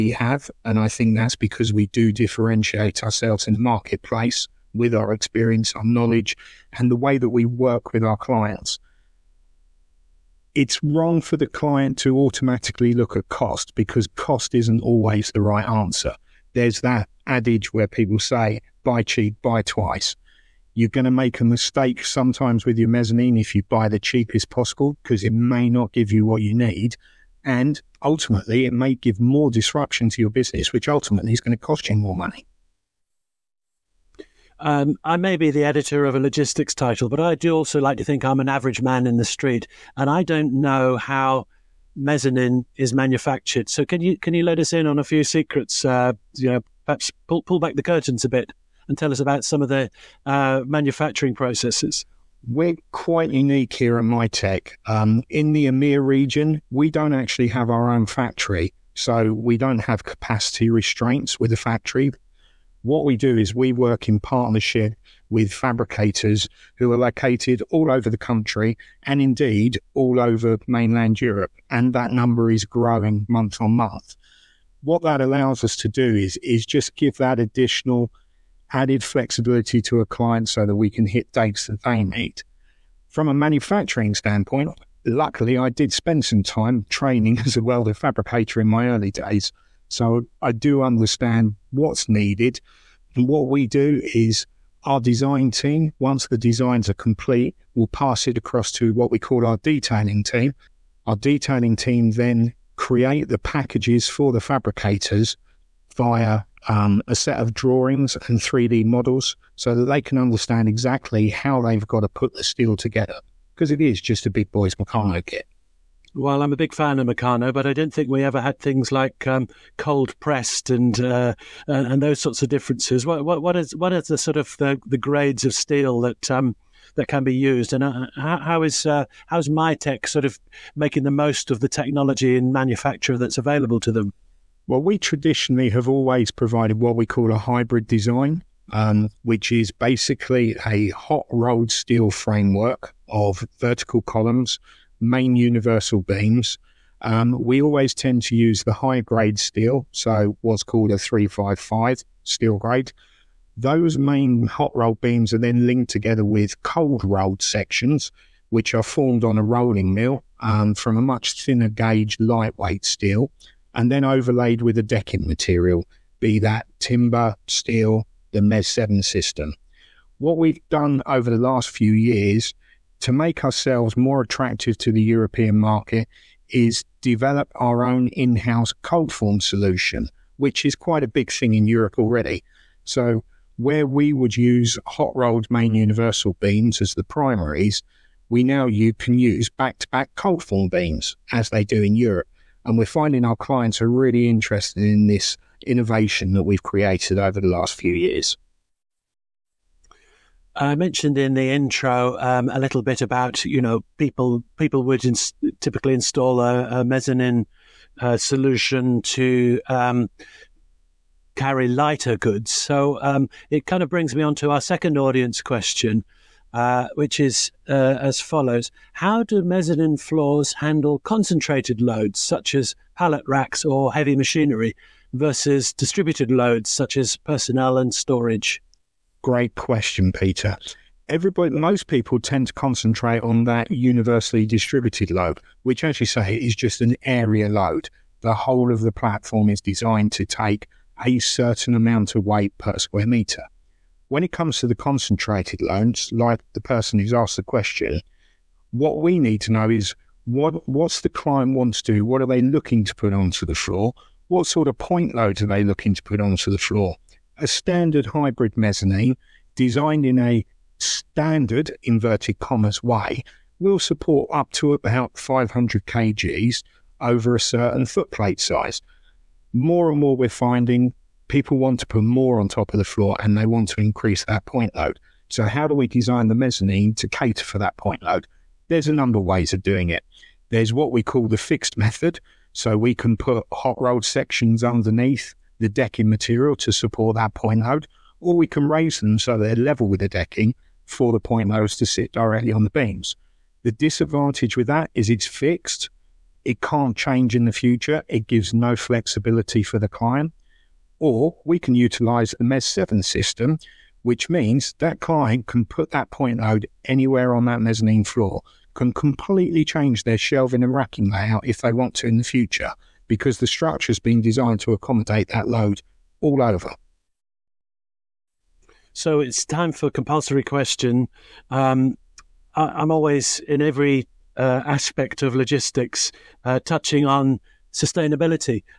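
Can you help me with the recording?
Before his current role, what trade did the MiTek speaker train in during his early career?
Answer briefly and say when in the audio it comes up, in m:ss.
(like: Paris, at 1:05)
Welder fabricator, at 1:27.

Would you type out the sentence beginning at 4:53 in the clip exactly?
The disadvantage with that is it's fixed.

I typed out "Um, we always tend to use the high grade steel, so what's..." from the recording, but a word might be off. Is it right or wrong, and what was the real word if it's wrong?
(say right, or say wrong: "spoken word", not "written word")
right.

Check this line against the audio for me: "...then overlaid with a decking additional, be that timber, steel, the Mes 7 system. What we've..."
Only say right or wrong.
wrong.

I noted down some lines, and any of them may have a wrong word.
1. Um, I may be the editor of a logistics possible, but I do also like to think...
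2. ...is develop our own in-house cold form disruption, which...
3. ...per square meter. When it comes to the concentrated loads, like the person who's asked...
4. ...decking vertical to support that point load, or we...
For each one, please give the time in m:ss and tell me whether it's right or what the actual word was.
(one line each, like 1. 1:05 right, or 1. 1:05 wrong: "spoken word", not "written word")
1. 0:34 wrong: "title", not "possible"
2. 2:56 wrong: "solution", not "disruption"
3. 4:02 right
4. 4:45 wrong: "material", not "vertical".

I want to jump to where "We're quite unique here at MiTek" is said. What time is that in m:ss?
0:52.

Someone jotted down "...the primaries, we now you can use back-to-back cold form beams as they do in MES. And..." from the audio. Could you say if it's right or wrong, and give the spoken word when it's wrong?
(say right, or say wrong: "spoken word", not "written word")
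wrong: "Europe", not "MES".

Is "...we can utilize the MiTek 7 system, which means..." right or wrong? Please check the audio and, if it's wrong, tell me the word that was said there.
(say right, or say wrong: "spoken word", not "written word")
wrong: "MES", not "MiTek".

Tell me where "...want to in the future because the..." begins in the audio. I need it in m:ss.
5:11.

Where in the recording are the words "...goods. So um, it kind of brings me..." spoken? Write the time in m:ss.
3:32.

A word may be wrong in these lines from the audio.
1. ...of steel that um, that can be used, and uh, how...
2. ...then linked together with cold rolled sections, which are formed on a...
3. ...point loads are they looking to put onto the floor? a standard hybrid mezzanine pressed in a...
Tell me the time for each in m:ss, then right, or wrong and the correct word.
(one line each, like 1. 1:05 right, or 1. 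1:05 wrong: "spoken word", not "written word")
1. 2:05 right
2. 2:35 right
3. 4:14 wrong: "designed", not "pressed".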